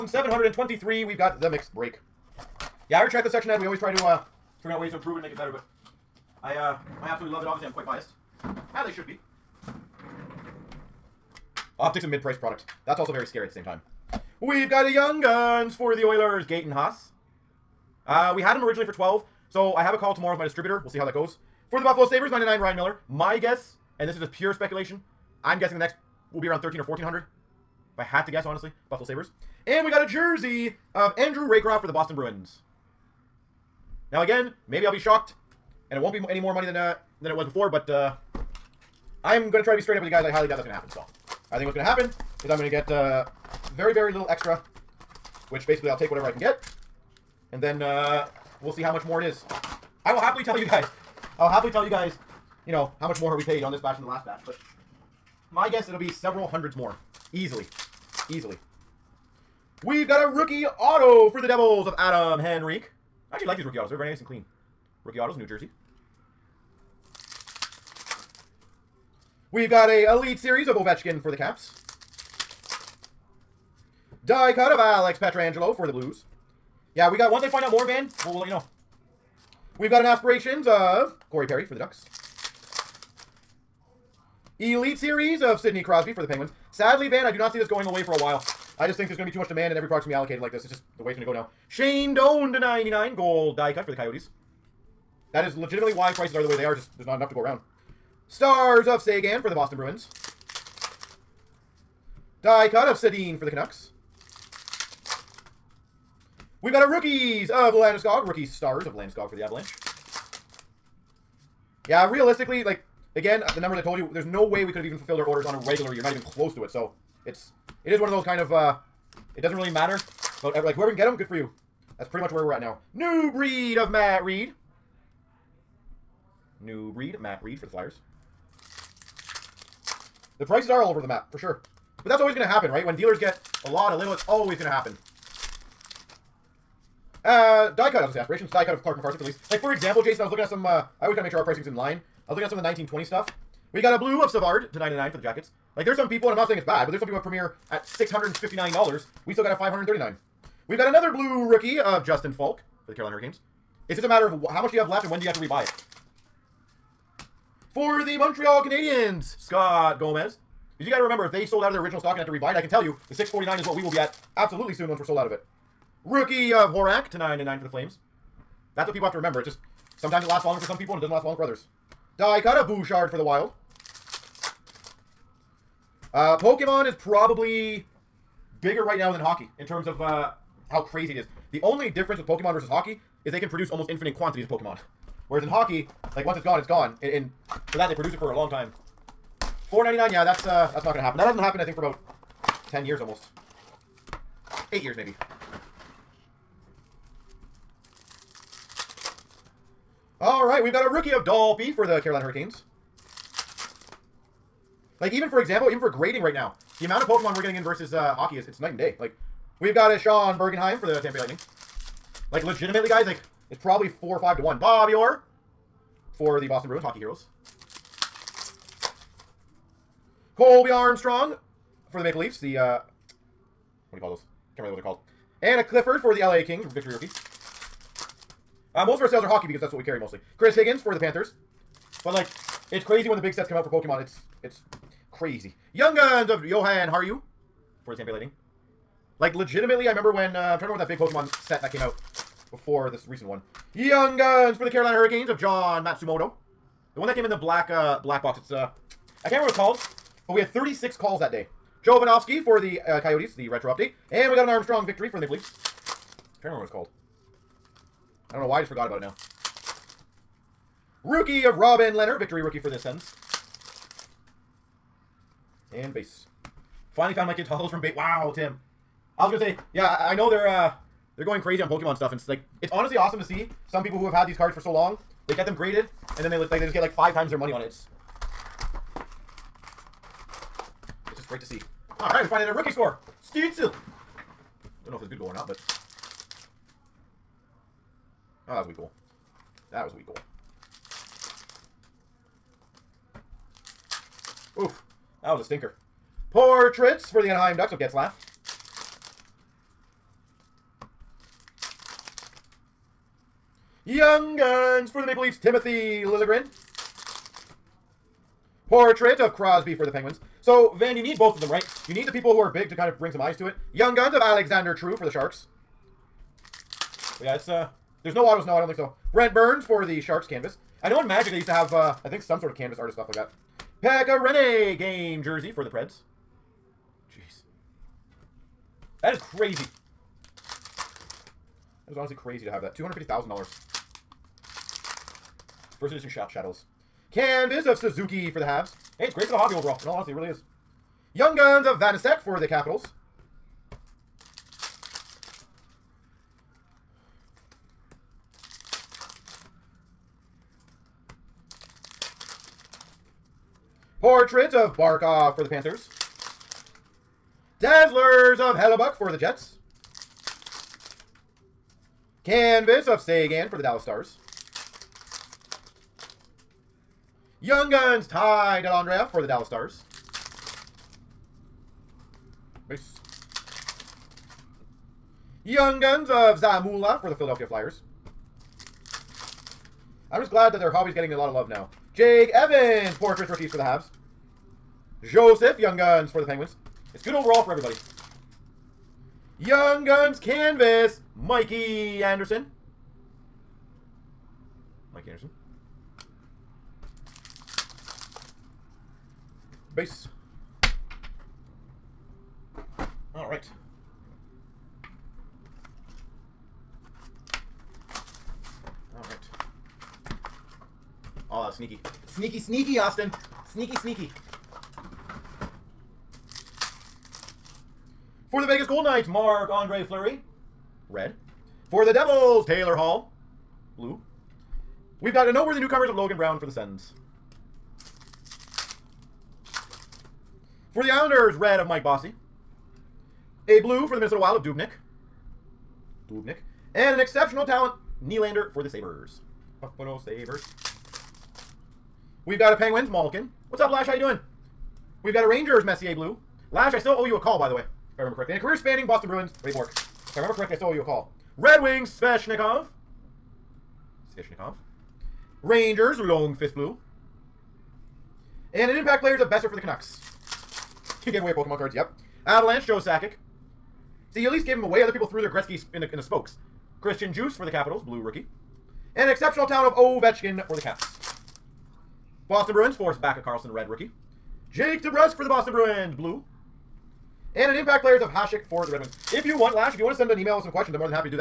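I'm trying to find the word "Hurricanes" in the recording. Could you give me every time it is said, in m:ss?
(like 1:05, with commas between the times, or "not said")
2:33, 3:22, 4:04.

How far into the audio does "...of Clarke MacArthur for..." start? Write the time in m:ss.
2:18.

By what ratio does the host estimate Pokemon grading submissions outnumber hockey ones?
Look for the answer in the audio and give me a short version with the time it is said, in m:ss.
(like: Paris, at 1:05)
4 or 5 to 1, at 3:33.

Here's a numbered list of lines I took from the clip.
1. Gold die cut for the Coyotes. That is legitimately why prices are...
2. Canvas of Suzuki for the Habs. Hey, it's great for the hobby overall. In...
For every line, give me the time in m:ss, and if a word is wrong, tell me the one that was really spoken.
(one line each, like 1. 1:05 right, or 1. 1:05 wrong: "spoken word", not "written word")
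1. 1:33 right
2. 5:37 right.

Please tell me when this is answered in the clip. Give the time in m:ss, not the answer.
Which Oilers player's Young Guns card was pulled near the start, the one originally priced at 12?
0:16.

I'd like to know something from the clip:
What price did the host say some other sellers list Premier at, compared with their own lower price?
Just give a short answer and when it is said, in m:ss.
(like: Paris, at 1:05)
$659, at 2:27.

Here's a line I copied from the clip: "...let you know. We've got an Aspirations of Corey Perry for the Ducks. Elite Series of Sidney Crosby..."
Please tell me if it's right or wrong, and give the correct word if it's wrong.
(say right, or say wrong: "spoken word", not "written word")
right.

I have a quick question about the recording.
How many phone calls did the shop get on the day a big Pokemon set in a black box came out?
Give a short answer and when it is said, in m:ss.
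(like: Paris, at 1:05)
36, at 4:10.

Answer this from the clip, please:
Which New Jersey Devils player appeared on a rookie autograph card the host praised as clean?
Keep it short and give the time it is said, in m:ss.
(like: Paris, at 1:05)
Adam Henrique, at 1:01.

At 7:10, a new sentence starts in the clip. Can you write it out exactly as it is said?
For the Islanders, red of Mike Bossy.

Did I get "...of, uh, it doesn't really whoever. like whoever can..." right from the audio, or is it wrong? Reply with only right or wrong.
wrong.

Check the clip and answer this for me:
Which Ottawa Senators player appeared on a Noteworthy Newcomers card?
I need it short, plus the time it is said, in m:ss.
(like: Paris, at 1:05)
Logan Brown, at 7:05.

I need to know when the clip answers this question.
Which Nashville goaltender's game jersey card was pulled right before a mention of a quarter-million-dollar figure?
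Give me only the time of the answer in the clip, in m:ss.
5:23.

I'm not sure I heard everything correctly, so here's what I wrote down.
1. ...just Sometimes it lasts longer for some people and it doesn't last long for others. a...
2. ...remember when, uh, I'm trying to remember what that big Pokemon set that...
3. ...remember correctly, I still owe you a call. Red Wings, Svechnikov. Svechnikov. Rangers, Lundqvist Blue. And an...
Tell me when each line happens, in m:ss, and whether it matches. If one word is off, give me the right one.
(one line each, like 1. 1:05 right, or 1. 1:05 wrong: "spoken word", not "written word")
1. 2:49 right
2. 3:59 right
3. 7:30 right.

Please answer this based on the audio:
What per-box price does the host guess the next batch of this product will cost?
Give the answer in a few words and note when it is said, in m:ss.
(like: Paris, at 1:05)
13 or 1400, at 0:26.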